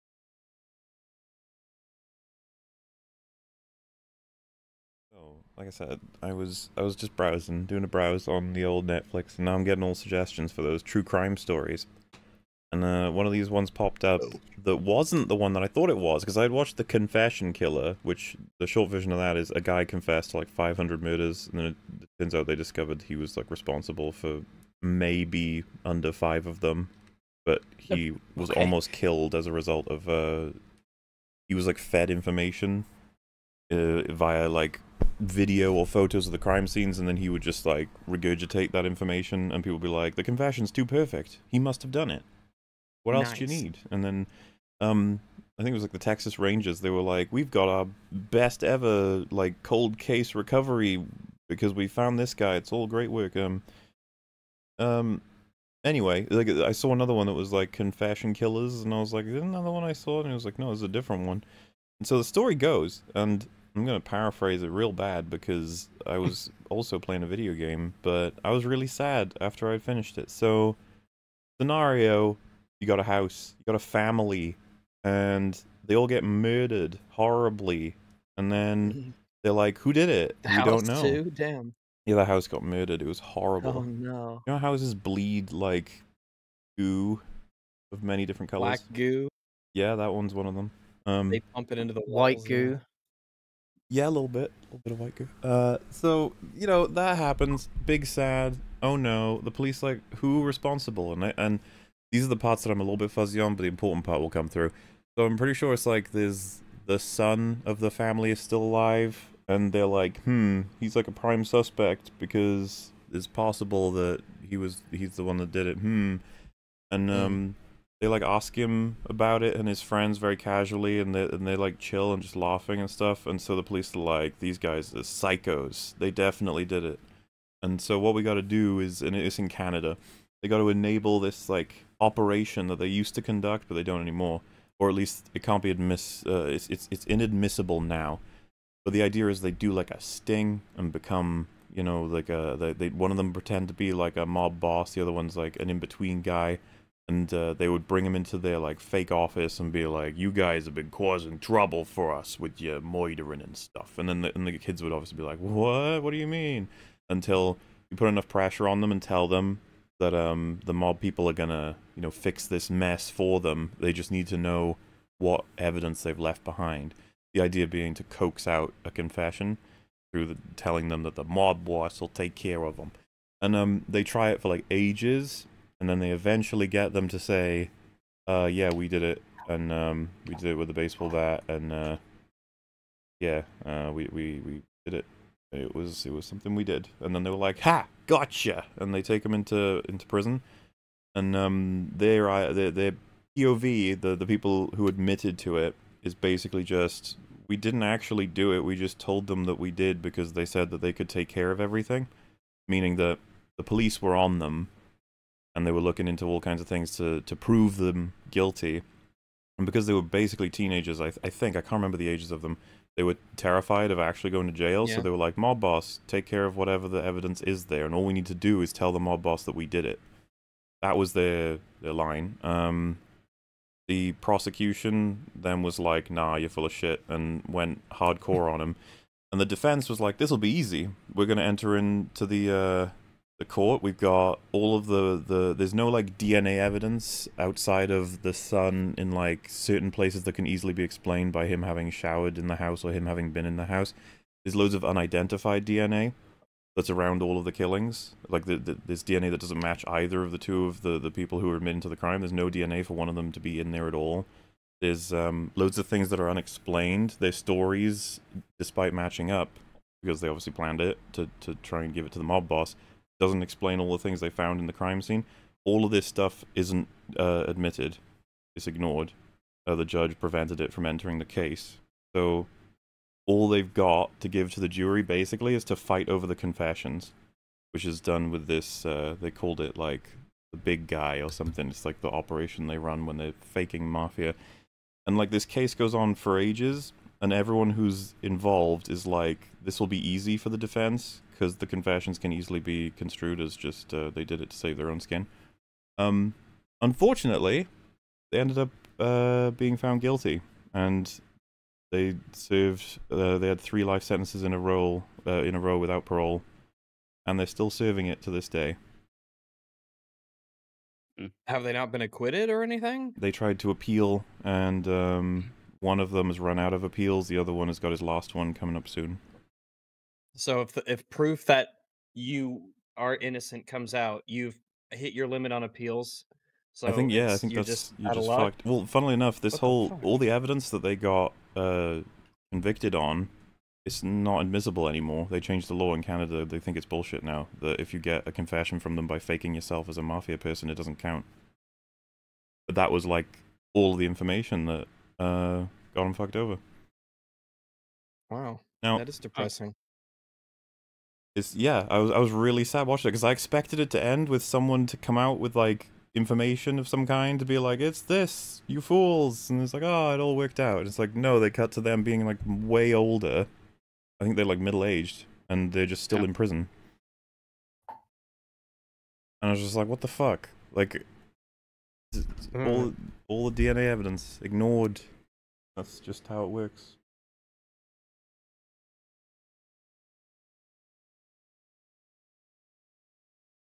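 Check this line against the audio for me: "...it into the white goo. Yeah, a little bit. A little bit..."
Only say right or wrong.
right.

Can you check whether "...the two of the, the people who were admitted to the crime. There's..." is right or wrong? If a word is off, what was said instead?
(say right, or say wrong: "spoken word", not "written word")
right.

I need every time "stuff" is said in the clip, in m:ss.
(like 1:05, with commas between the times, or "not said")
2:02, 2:33, 4:26.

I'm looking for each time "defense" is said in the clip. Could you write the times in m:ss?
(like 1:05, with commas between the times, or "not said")
3:49, 4:50.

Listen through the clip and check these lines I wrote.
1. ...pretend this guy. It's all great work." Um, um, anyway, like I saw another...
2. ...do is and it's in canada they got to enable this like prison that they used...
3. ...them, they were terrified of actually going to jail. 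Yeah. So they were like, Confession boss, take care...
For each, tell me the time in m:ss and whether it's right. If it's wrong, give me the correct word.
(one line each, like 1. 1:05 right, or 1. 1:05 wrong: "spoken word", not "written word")
1. 0:51 wrong: "found", not "pretend"
2. 2:08 wrong: "operation", not "prison"
3. 3:32 wrong: "Mob", not "Confession".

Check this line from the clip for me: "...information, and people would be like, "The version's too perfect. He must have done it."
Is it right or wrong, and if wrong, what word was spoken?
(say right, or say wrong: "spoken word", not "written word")
wrong: "confession", not "version".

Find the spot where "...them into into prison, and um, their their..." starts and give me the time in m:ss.
3:09.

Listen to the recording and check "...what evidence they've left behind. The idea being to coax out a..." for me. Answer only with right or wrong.
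right.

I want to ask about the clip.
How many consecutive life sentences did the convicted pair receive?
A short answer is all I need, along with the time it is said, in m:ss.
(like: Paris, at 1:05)
3, at 5:03.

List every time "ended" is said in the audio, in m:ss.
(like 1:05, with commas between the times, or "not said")
4:58.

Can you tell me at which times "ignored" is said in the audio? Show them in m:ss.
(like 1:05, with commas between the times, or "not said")
4:28, 6:14.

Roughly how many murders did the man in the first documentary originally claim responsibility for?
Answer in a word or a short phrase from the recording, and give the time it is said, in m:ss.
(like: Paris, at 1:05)
500, at 0:20.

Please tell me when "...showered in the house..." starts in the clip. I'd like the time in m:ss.
4:01.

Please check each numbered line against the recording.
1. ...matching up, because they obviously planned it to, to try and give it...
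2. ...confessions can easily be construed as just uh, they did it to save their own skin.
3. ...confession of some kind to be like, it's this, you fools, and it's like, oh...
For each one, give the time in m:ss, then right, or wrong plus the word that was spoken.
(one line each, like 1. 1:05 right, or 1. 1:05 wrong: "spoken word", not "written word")
1. 4:18 right
2. 4:51 right
3. 5:56 wrong: "information", not "confession".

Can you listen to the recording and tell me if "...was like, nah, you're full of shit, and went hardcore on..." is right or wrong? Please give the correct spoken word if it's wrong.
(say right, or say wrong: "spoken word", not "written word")
right.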